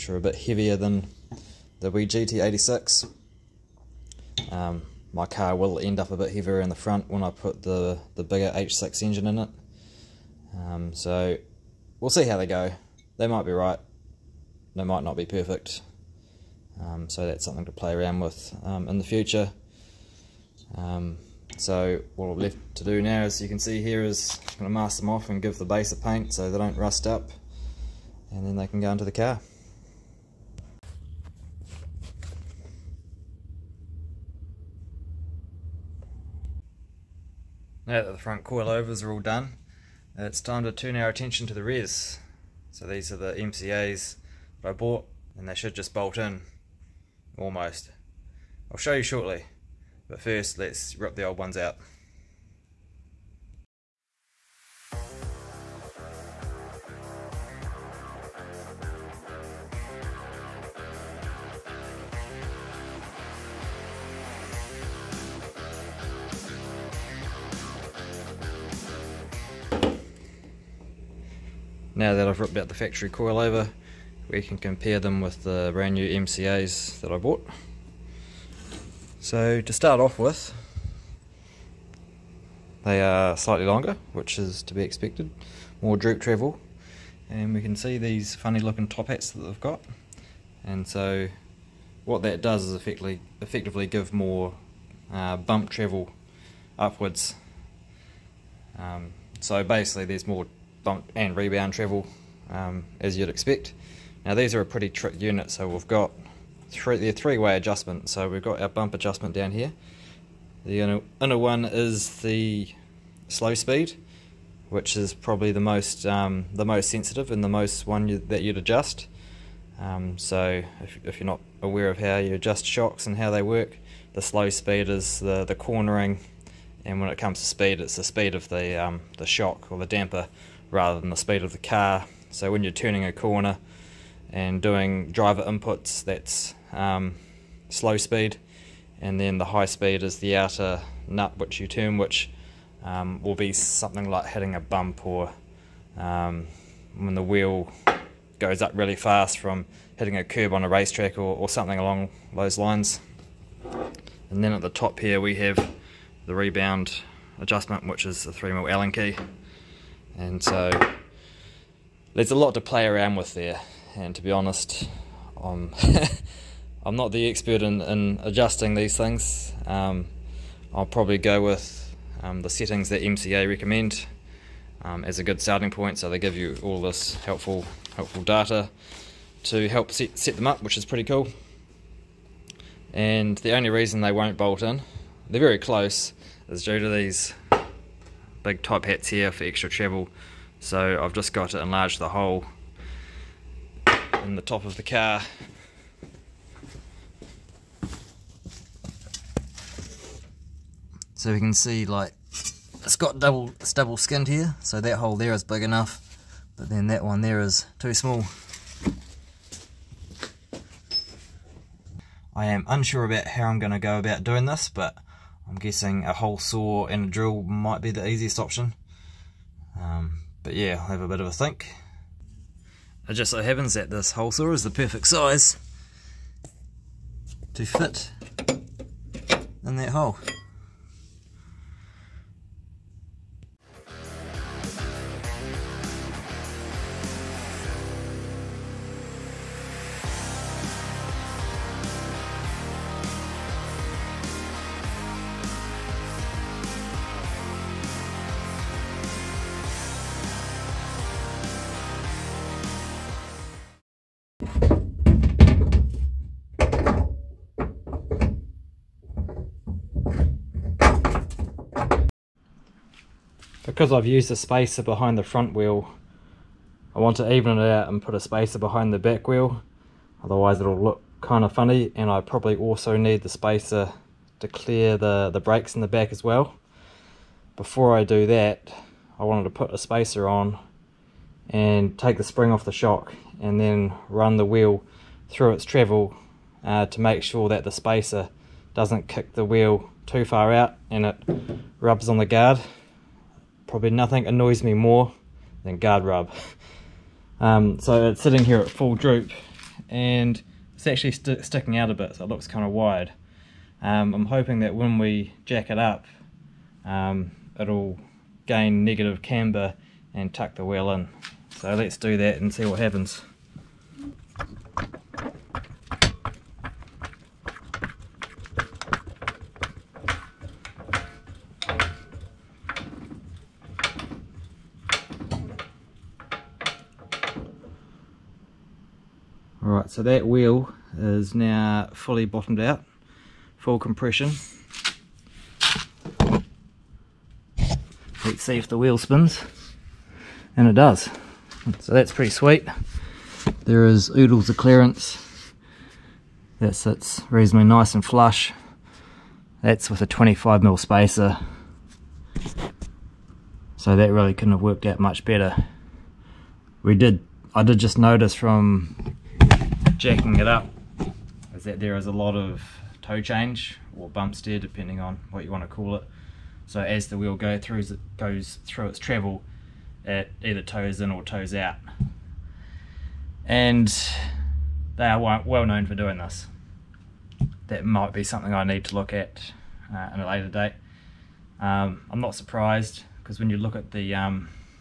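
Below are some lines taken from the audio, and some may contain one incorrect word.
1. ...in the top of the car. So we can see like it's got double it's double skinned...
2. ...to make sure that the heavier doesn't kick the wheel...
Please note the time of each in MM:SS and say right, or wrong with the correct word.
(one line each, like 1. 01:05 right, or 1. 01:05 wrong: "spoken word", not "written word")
1. 03:14 right
2. 04:46 wrong: "spacer", not "heavier".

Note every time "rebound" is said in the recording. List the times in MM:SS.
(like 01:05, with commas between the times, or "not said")
01:41, 02:36.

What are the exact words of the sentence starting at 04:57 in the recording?
Um, so it's sitting here at full droop and it's actually st sticking out a bit so it looks kind of wide.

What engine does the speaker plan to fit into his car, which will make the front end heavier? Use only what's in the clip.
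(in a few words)
H6 engine.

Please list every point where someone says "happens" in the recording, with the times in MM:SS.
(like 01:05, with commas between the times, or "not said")
03:43, 05:12.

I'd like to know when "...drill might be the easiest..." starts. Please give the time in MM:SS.
03:37.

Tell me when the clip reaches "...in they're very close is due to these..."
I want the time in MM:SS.
03:04.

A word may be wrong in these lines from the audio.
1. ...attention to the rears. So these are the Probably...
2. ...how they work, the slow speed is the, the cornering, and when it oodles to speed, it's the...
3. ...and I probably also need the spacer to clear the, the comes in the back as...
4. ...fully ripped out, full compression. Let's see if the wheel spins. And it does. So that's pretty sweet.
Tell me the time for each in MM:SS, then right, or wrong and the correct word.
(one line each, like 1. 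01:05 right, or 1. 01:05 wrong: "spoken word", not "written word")
1. 00:41 wrong: "MCAs", not "Probably"
2. 02:03 wrong: "comes", not "oodles"
3. 04:31 wrong: "brakes", not "comes"
4. 05:31 wrong: "bottomed", not "ripped".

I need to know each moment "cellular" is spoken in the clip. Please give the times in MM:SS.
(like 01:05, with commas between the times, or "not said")
not said.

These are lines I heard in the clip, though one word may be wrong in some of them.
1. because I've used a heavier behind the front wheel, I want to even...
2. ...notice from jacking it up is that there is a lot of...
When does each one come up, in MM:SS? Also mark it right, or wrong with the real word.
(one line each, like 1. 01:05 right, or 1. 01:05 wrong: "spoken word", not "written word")
1. 04:23 wrong: "spacer", not "heavier"
2. 05:57 right.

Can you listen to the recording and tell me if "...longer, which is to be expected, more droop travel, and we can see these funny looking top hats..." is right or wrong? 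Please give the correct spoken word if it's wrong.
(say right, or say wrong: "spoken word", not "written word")
right.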